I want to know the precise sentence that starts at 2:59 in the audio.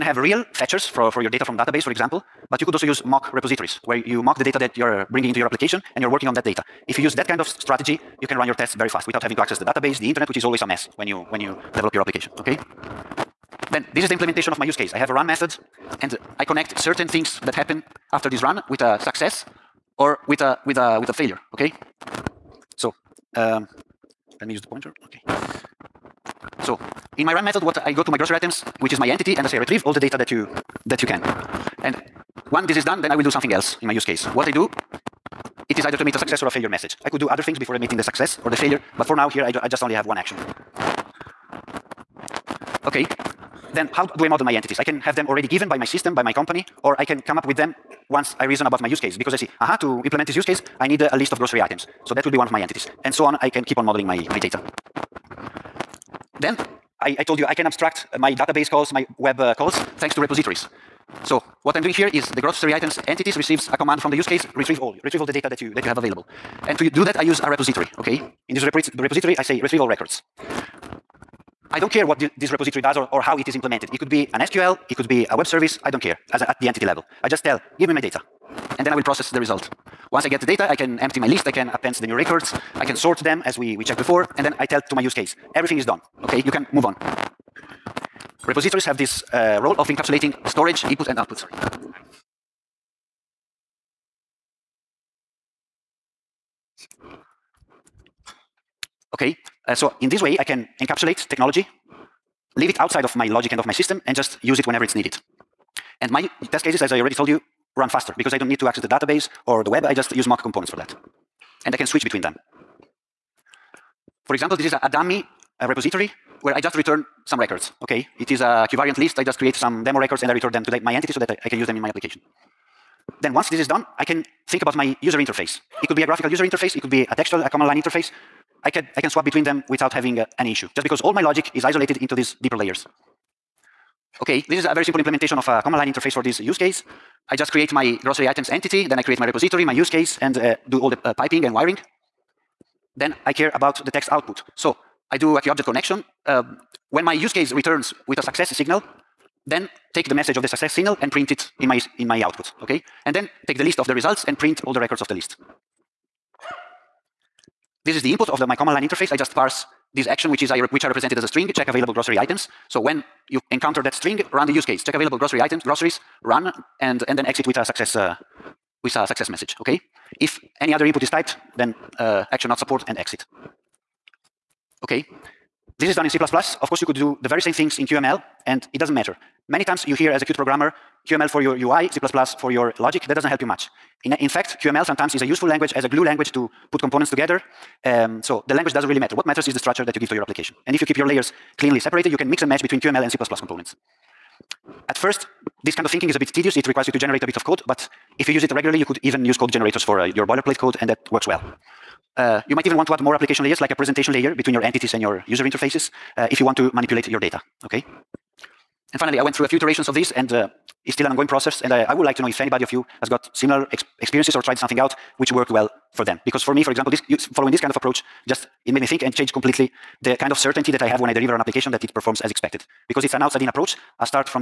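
Many times you hear as a Qt programmer, QML for your UI, C++ for your logic, that doesn't help you much.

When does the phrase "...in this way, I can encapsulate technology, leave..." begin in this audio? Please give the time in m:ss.
1:40.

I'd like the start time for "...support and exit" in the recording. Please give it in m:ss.
2:52.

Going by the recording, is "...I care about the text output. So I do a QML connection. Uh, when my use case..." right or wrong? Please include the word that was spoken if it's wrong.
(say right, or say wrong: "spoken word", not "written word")
wrong: "QObject", not "QML".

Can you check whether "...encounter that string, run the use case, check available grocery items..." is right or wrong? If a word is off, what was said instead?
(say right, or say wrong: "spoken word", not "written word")
right.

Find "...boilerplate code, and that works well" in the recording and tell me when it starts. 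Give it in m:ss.
3:20.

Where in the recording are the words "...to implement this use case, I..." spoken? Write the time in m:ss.
0:49.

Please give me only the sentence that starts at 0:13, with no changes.
Then, this is the implementation of my use case.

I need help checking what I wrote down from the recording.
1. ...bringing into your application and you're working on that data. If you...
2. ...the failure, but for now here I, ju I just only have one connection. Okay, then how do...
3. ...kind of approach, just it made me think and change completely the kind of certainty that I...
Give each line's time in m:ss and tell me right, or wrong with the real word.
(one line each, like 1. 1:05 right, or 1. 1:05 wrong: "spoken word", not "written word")
1. 0:05 right
2. 0:38 wrong: "action", not "connection"
3. 3:37 right.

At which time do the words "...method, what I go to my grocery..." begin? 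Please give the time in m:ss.
0:27.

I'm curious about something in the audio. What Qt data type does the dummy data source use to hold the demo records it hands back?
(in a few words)
QVariantList.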